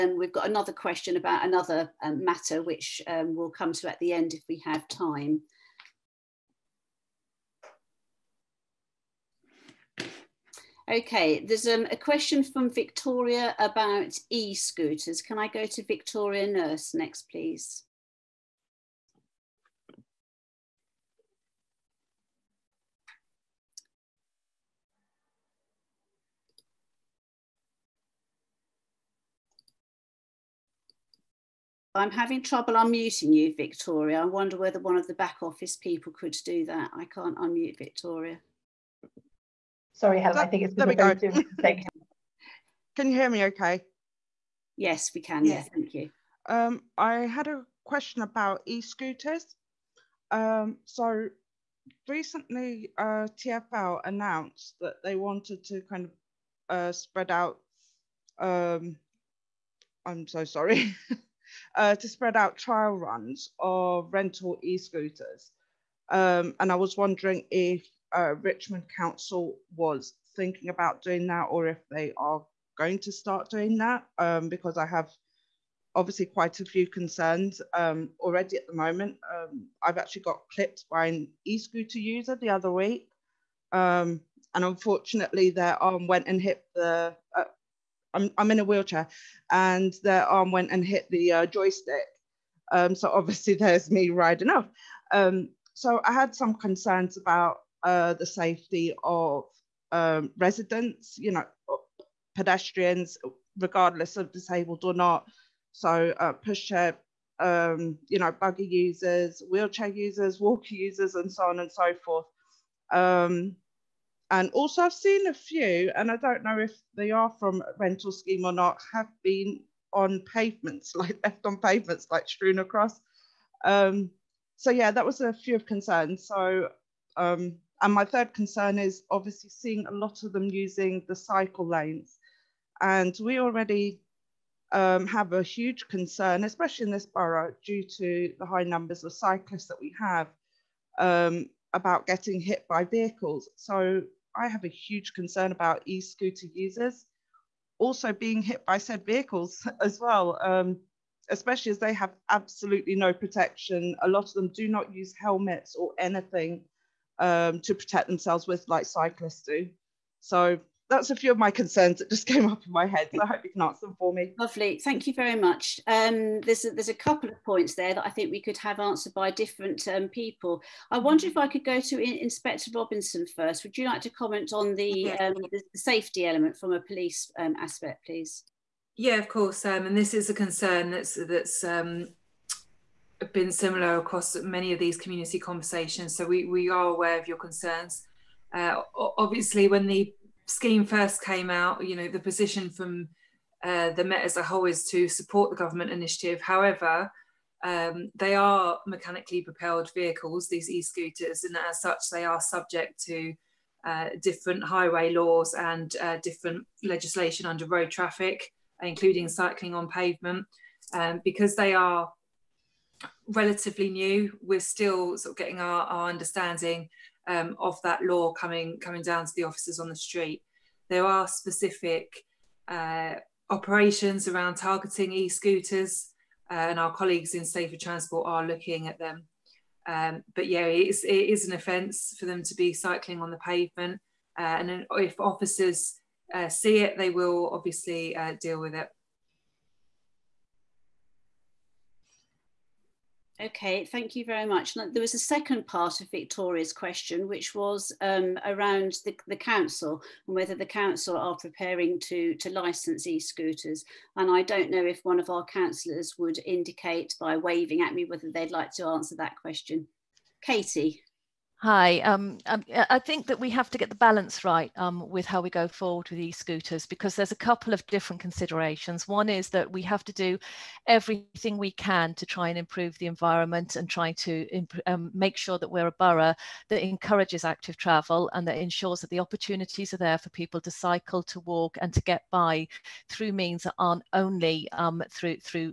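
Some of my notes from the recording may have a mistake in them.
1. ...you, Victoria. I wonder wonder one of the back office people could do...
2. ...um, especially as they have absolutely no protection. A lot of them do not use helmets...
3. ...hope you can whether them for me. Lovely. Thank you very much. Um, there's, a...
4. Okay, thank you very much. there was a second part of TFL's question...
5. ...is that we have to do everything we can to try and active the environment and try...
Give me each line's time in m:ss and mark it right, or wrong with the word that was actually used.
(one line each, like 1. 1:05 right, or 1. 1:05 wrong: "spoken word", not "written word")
1. 0:33 wrong: "whether", not "wonder"
2. 2:30 right
3. 2:43 wrong: "answer", not "whether"
4. 4:03 wrong: "Victoria", not "TFL"
5. 4:29 wrong: "improve", not "active".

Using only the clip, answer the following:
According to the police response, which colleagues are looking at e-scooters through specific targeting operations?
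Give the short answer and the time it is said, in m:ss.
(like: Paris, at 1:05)
Safer Transport, at 3:47.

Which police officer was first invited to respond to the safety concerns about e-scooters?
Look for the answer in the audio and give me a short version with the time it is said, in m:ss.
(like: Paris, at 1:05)
Inspector Robinson, at 2:52.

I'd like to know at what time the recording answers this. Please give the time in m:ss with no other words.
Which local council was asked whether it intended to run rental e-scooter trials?
1:08.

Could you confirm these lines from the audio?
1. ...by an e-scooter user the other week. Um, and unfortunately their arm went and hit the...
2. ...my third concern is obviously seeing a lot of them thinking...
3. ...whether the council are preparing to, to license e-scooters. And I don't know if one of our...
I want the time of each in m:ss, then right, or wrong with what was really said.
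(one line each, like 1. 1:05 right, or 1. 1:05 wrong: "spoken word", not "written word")
1. 1:20 right
2. 2:07 wrong: "using", not "thinking"
3. 4:10 right.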